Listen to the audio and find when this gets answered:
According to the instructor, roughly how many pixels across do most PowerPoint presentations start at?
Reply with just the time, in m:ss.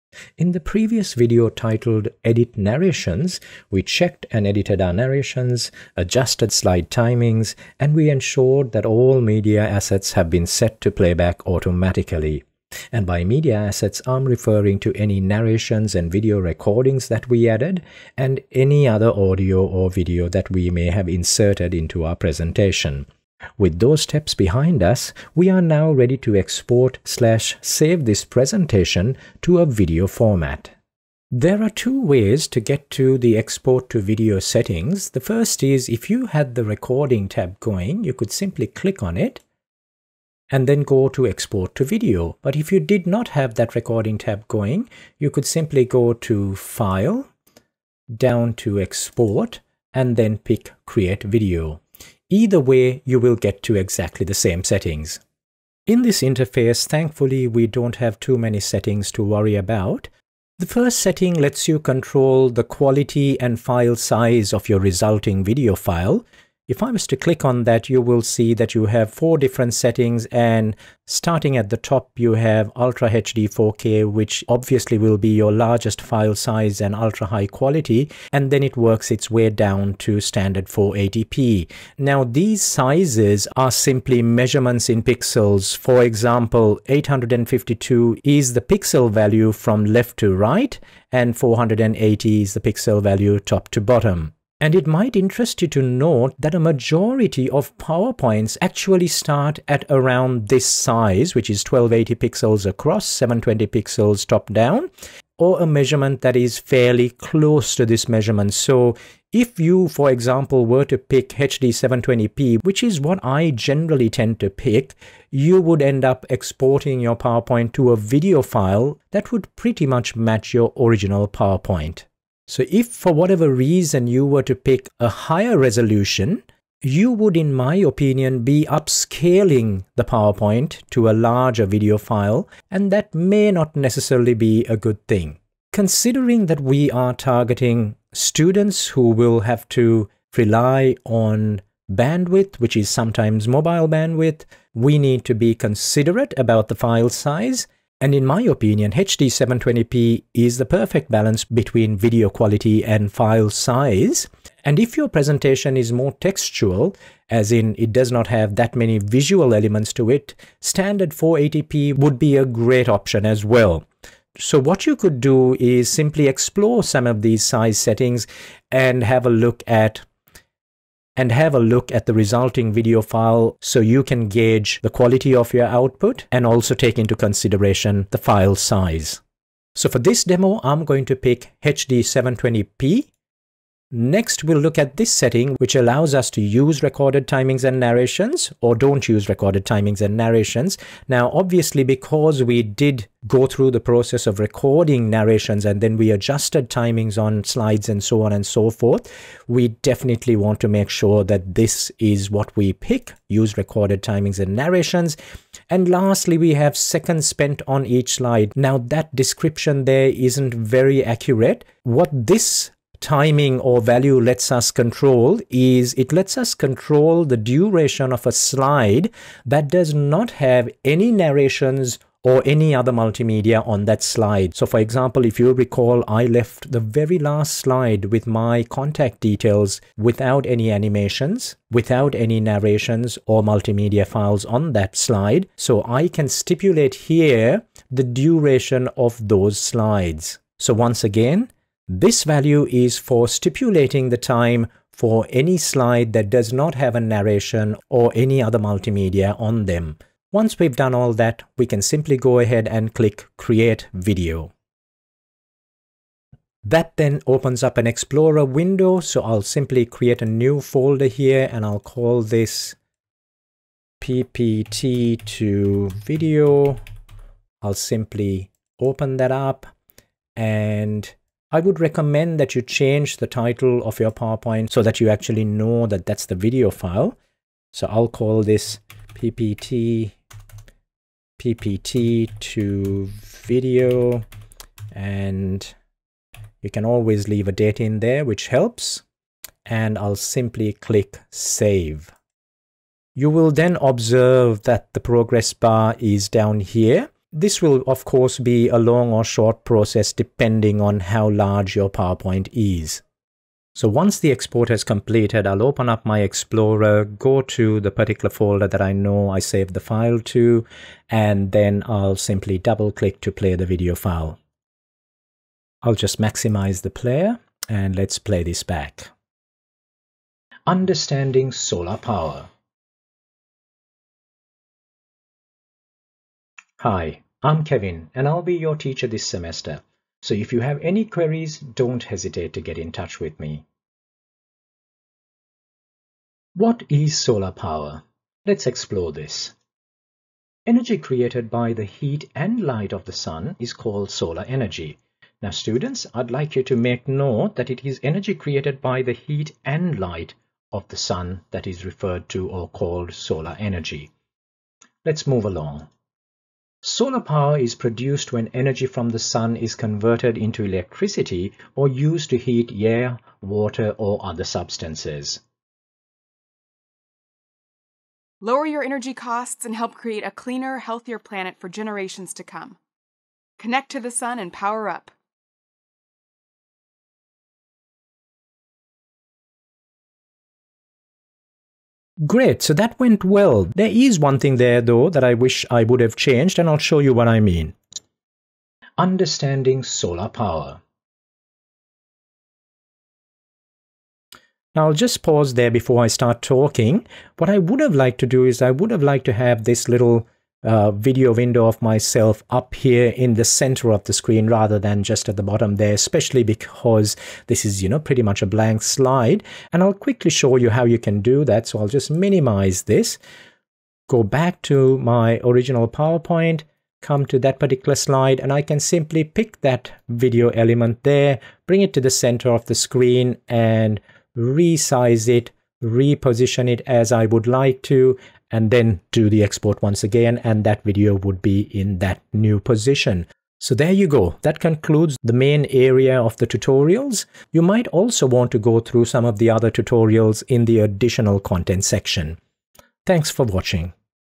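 1:41.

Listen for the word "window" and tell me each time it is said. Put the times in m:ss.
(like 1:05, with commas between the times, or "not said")
4:18, 6:41.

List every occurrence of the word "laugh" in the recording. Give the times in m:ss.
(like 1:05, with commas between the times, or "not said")
not said.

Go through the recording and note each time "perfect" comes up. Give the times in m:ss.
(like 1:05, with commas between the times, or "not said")
2:30.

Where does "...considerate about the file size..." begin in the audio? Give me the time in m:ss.
2:25.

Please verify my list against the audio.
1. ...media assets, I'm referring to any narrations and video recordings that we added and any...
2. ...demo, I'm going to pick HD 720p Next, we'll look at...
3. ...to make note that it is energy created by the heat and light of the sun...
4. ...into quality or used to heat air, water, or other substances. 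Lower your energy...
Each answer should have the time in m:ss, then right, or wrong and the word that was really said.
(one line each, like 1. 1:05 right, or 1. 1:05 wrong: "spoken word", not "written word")
1. 0:13 right
2. 3:00 right
3. 5:46 right
4. 6:00 wrong: "electricity", not "quality".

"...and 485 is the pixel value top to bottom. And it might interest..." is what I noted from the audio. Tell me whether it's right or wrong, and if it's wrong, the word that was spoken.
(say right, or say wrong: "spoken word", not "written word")
wrong: "480", not "485".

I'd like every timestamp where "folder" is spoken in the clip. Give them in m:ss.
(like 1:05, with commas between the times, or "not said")
4:20, 5:08.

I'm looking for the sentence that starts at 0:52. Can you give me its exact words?
Either way, you will get to exactly the same settings.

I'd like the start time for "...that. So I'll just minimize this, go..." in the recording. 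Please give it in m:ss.
6:51.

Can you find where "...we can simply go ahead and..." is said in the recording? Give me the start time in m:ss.
4:11.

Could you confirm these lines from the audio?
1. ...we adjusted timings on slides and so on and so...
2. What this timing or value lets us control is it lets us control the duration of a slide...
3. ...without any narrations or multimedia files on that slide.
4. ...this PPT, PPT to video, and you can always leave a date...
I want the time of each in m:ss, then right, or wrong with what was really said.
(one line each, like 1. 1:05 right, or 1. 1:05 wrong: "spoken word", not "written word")
1. 3:15 right
2. 3:31 right
3. 3:51 right
4. 4:38 right.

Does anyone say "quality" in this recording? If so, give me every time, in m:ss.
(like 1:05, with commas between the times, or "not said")
1:02, 1:17, 2:32, 2:54.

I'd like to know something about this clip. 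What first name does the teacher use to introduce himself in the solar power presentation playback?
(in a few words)
Kevin.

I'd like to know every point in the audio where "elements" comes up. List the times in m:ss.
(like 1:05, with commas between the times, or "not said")
2:39, 7:00.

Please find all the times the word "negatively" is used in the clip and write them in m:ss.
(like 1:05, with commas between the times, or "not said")
not said.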